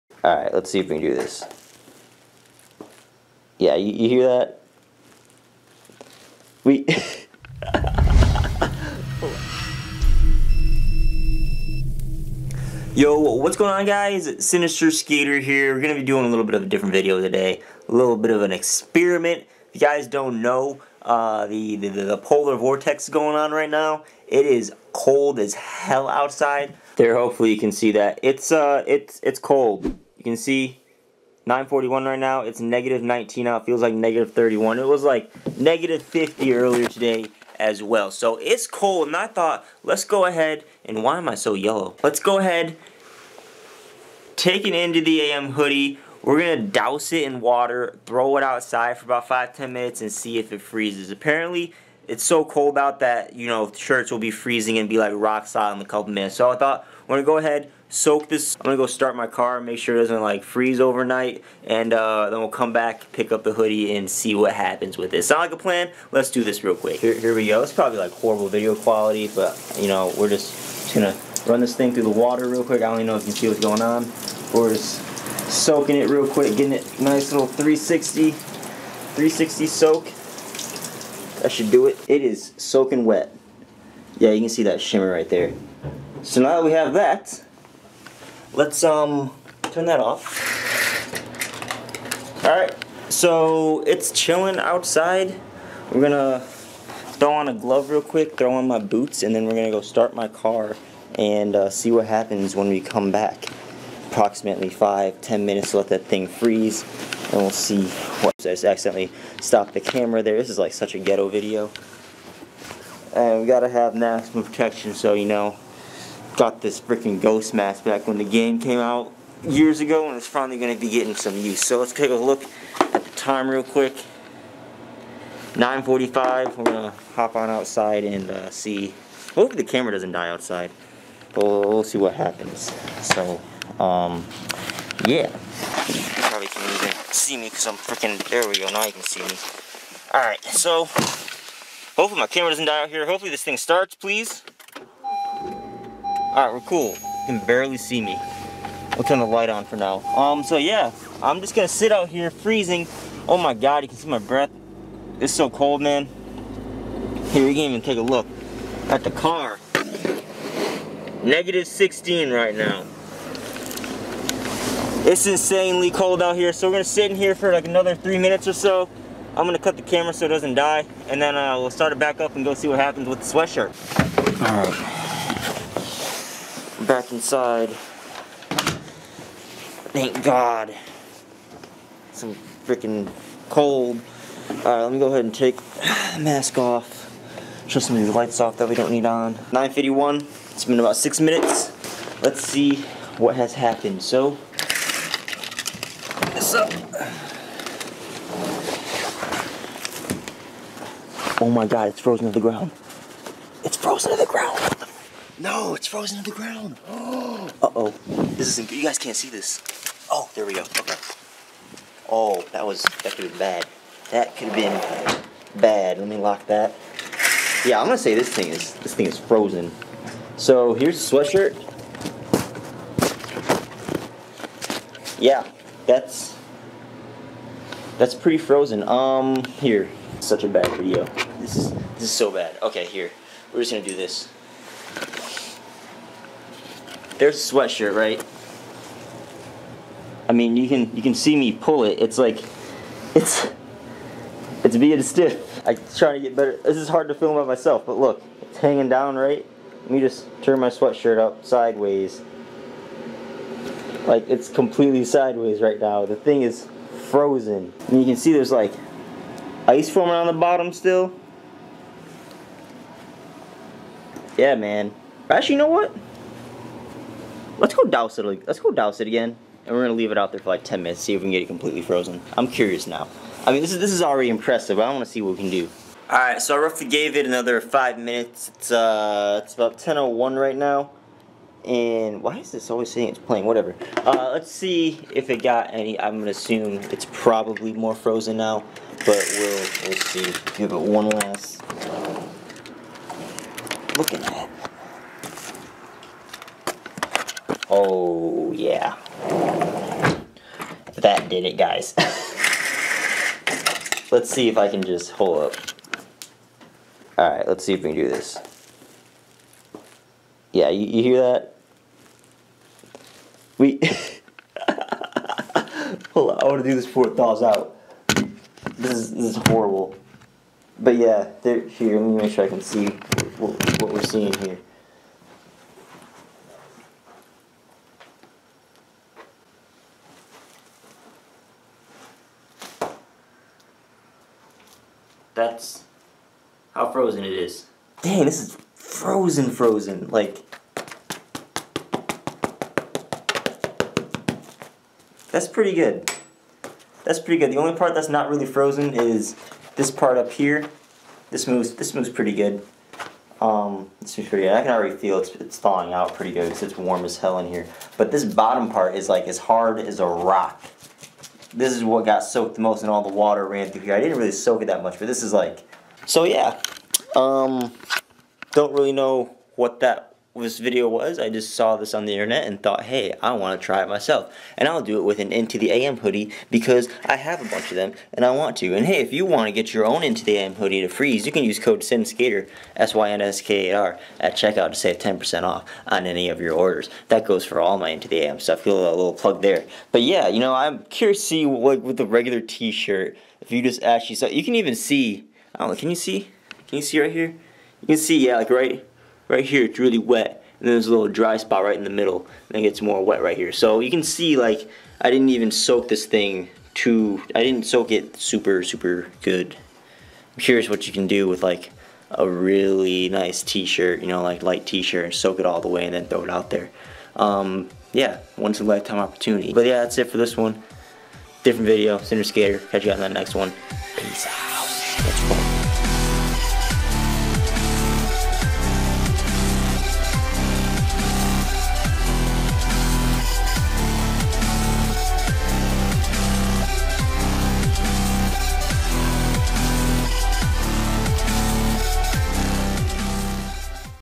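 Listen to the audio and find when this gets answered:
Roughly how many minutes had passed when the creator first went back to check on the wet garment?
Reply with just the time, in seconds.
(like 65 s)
190 s.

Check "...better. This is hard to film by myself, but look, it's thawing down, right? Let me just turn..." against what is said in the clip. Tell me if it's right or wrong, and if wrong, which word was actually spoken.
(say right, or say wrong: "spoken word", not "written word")
wrong: "hanging", not "thawing".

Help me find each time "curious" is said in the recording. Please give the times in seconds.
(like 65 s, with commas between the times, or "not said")
272 s, 390 s, 410 s.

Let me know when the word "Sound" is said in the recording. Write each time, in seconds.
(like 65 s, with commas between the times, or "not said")
65 s.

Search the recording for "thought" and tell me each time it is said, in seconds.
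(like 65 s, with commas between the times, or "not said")
39 s, 56 s, 372 s.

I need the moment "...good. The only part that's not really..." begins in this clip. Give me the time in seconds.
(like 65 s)
347 s.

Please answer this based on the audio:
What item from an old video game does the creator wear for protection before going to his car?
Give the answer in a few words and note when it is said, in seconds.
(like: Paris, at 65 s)
ghost mask, at 117 s.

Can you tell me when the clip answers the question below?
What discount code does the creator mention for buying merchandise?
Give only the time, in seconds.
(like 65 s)
381 s.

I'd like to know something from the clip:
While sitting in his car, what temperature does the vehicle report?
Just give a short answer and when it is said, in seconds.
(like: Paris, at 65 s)
-16, at 161 s.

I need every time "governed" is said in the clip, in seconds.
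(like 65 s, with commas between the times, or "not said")
not said.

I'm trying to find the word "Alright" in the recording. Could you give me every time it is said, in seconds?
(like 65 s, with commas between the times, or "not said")
140 s, 146 s, 184 s, 307 s.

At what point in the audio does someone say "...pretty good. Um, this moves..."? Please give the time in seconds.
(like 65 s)
352 s.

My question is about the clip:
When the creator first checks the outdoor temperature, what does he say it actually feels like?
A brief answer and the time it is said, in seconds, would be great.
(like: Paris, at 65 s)
-31, at 33 s.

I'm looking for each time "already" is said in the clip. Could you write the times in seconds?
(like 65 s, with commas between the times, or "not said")
274 s, 354 s.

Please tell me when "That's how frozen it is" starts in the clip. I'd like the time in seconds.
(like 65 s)
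335 s.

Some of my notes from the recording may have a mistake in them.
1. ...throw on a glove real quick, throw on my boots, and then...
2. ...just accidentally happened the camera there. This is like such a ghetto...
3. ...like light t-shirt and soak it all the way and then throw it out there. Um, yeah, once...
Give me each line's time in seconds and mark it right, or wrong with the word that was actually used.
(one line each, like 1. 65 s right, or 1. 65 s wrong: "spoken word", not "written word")
1. 97 s right
2. 108 s wrong: "stopped", not "happened"
3. 414 s right.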